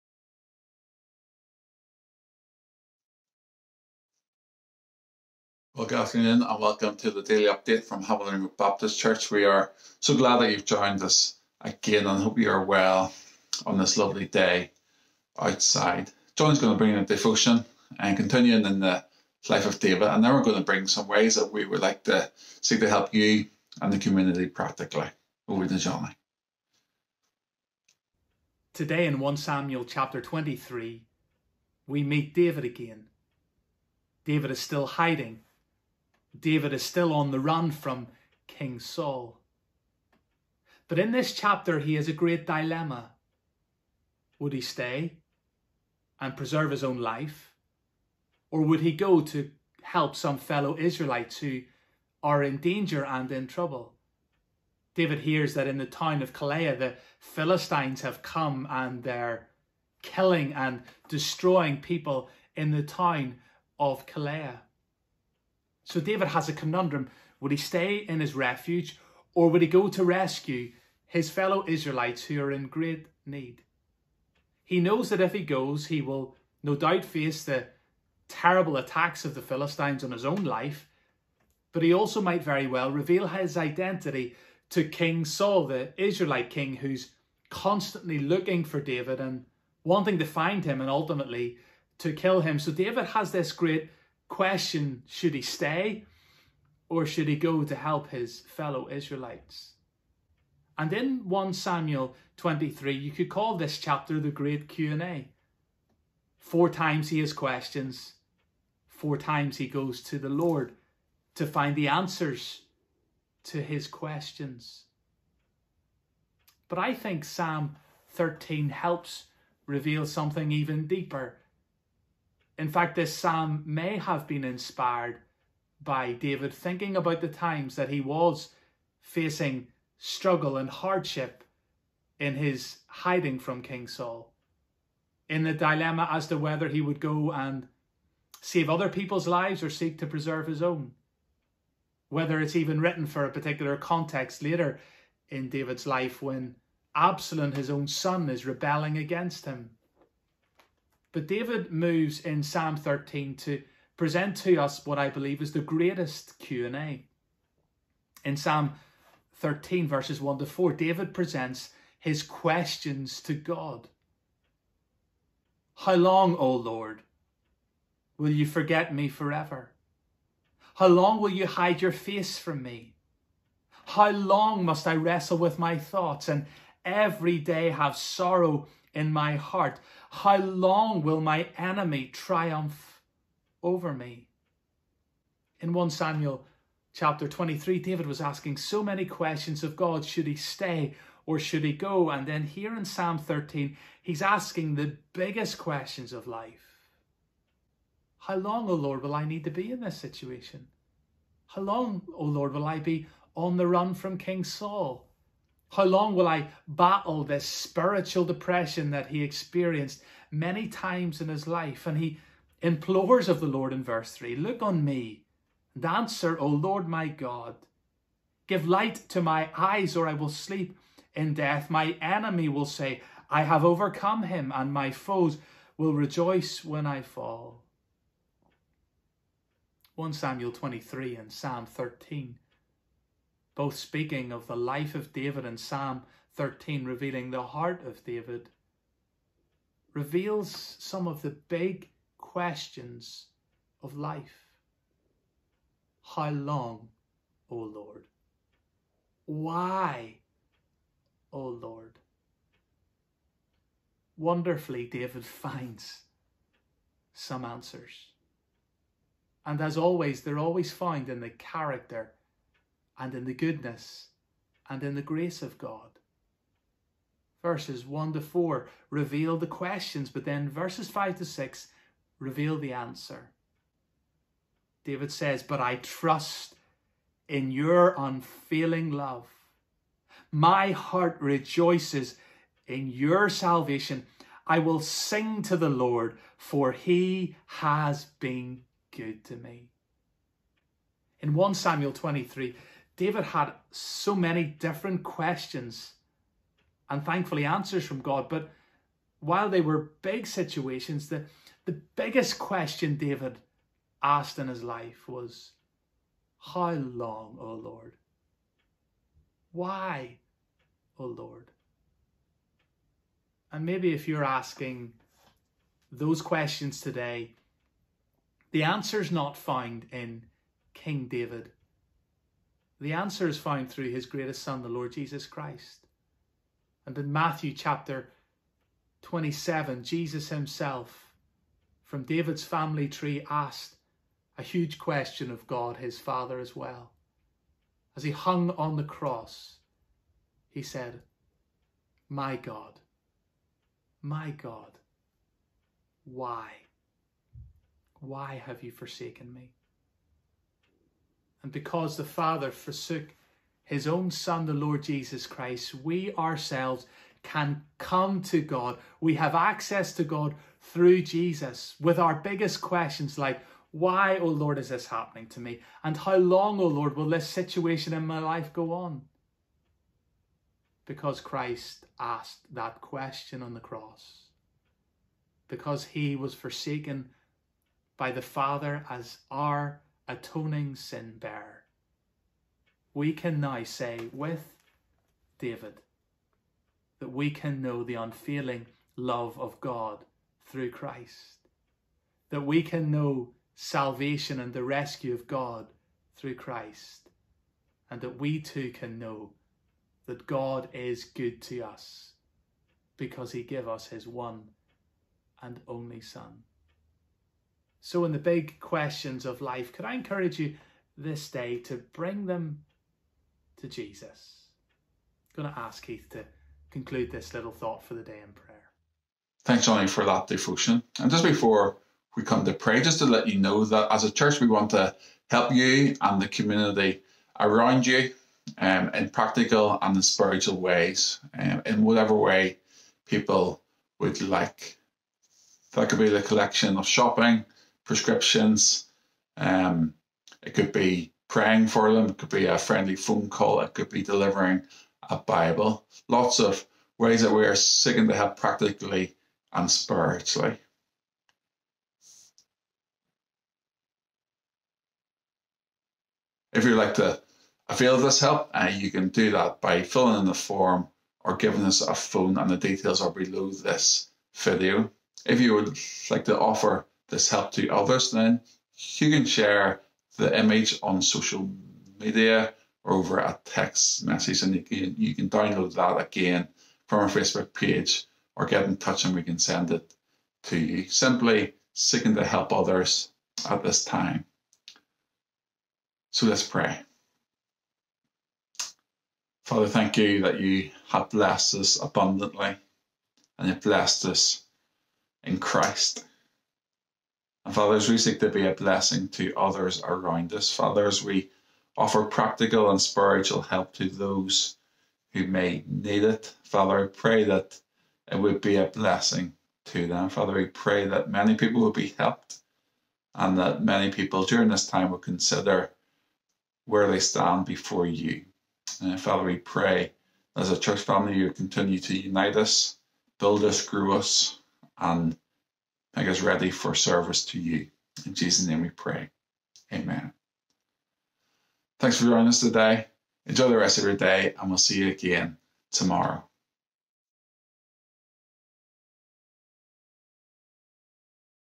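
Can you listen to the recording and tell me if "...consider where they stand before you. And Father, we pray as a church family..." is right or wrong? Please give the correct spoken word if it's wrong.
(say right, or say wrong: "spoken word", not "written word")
right.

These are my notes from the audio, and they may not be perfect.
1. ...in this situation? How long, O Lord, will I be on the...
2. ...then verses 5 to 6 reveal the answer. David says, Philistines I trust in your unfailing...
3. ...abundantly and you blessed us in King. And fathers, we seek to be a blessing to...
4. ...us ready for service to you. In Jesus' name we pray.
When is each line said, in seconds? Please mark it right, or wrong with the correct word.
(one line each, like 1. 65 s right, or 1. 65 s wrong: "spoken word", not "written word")
1. 199 s right
2. 270 s wrong: "But", not "Philistines"
3. 491 s wrong: "Christ", not "King"
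4. 526 s right.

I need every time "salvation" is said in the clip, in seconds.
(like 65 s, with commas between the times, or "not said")
283 s, 393 s.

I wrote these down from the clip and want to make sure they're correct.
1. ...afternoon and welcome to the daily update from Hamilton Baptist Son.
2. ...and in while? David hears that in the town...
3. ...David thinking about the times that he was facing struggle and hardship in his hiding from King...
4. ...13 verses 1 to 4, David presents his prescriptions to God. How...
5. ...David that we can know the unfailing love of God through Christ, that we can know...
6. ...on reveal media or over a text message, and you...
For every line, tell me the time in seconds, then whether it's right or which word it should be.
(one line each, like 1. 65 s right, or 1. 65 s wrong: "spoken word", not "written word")
1. 5 s wrong: "Church", not "Son"
2. 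53 s wrong: "trouble", not "while"
3. 126 s right
4. 159 s wrong: "questions", not "prescriptions"
5. 385 s right
6. 470 s wrong: "social", not "reveal".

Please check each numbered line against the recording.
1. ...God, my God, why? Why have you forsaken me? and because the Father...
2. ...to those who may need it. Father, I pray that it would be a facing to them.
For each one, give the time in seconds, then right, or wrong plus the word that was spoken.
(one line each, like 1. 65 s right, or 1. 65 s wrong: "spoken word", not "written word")
1. 342 s right
2. 503 s wrong: "blessing", not "facing".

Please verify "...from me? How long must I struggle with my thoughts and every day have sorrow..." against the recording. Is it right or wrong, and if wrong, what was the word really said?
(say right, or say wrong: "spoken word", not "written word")
wrong: "wrestle", not "struggle".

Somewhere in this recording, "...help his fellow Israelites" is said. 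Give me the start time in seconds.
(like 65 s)
97 s.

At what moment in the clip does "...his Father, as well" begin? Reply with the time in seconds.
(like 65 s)
335 s.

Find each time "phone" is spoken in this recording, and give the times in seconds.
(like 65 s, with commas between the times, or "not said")
442 s, 461 s.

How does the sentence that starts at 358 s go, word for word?
We have access to God through Jesus with our biggest questions like, why, O oh Lord, is this happening to me?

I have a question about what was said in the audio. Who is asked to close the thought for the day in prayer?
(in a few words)
Keith.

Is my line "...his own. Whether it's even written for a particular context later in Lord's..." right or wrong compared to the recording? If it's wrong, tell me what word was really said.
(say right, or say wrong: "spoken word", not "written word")
wrong: "David", not "Lord".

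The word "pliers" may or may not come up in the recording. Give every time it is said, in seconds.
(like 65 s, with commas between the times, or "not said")
not said.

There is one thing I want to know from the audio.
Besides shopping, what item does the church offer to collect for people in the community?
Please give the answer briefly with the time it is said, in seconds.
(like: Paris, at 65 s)
Prescriptions, at 437 s.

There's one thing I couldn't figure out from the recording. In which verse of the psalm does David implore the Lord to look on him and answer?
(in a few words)
Verse 3.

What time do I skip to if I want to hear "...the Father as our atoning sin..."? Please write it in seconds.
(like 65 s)
378 s.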